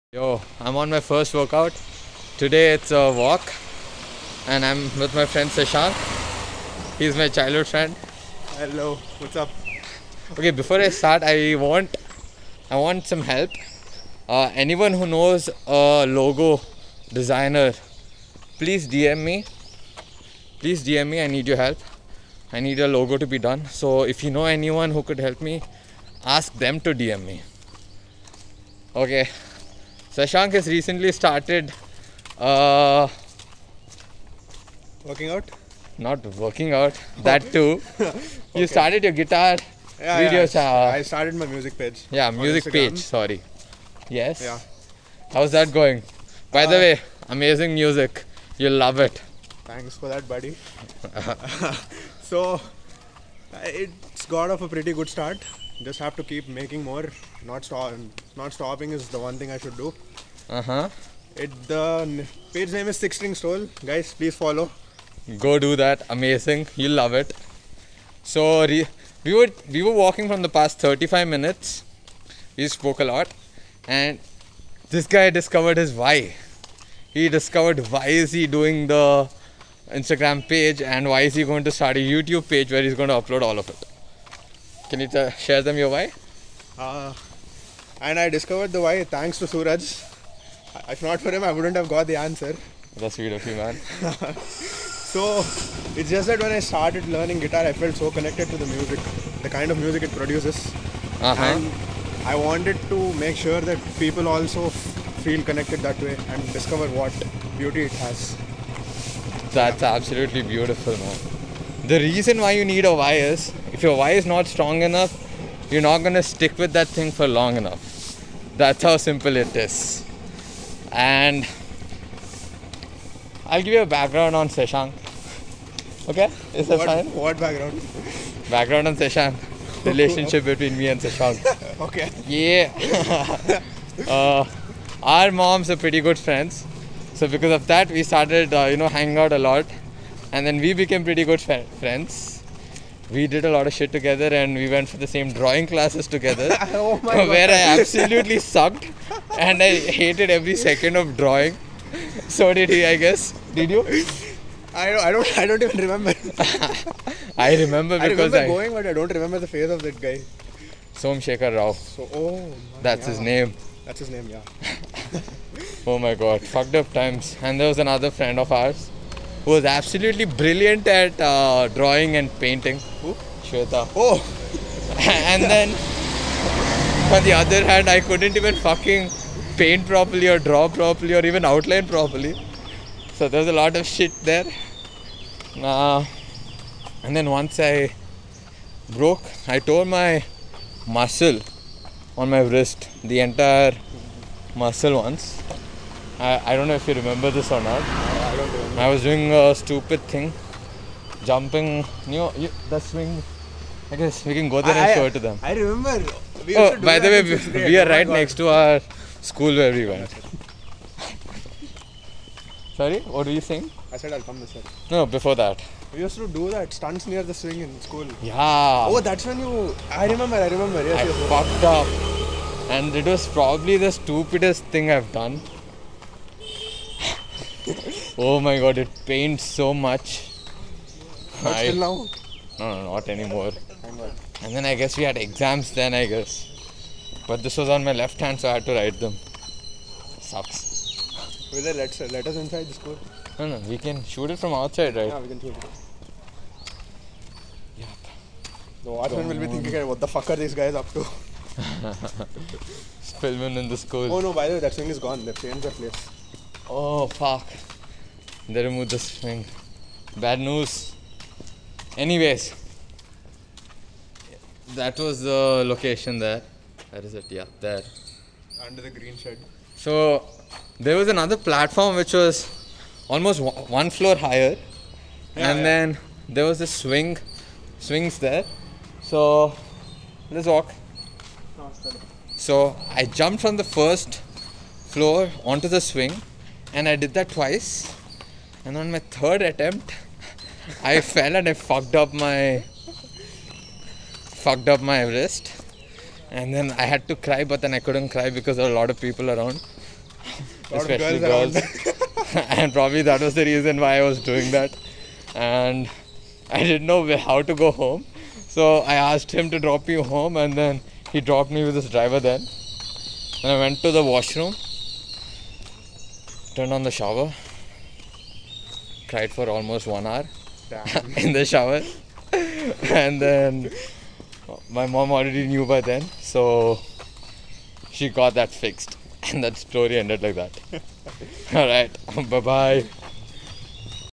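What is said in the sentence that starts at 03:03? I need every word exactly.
So there's a lot of shit there.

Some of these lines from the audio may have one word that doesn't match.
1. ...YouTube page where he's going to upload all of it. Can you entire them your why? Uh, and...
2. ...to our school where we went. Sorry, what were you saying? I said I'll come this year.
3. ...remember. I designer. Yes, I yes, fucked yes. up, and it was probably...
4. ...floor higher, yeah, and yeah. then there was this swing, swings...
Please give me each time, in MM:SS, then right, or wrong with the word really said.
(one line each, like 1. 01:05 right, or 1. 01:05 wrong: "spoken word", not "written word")
1. 01:21 wrong: "share", not "entire"
2. 03:28 right
3. 03:40 wrong: "remember", not "designer"
4. 04:33 right.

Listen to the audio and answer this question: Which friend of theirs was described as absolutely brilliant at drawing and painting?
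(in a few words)
Shweta.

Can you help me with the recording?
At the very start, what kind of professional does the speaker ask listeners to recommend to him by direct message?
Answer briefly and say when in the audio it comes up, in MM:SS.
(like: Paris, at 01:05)
Logo designer, at 00:16.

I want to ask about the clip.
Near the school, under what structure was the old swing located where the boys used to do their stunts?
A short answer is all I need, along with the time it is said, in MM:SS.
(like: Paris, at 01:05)
Green shed, at 04:28.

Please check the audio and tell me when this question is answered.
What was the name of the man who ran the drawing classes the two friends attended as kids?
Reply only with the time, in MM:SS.
02:40.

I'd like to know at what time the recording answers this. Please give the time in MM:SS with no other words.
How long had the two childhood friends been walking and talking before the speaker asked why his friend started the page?
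01:10.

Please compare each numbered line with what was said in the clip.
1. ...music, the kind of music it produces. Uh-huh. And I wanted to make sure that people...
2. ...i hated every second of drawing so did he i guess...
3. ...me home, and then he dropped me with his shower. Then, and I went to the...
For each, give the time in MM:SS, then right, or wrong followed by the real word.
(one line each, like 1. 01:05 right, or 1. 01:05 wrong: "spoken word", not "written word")
1. 01:38 right
2. 02:29 right
3. 05:09 wrong: "driver", not "shower".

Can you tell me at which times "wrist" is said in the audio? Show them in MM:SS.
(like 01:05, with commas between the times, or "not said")
03:12, 04:55.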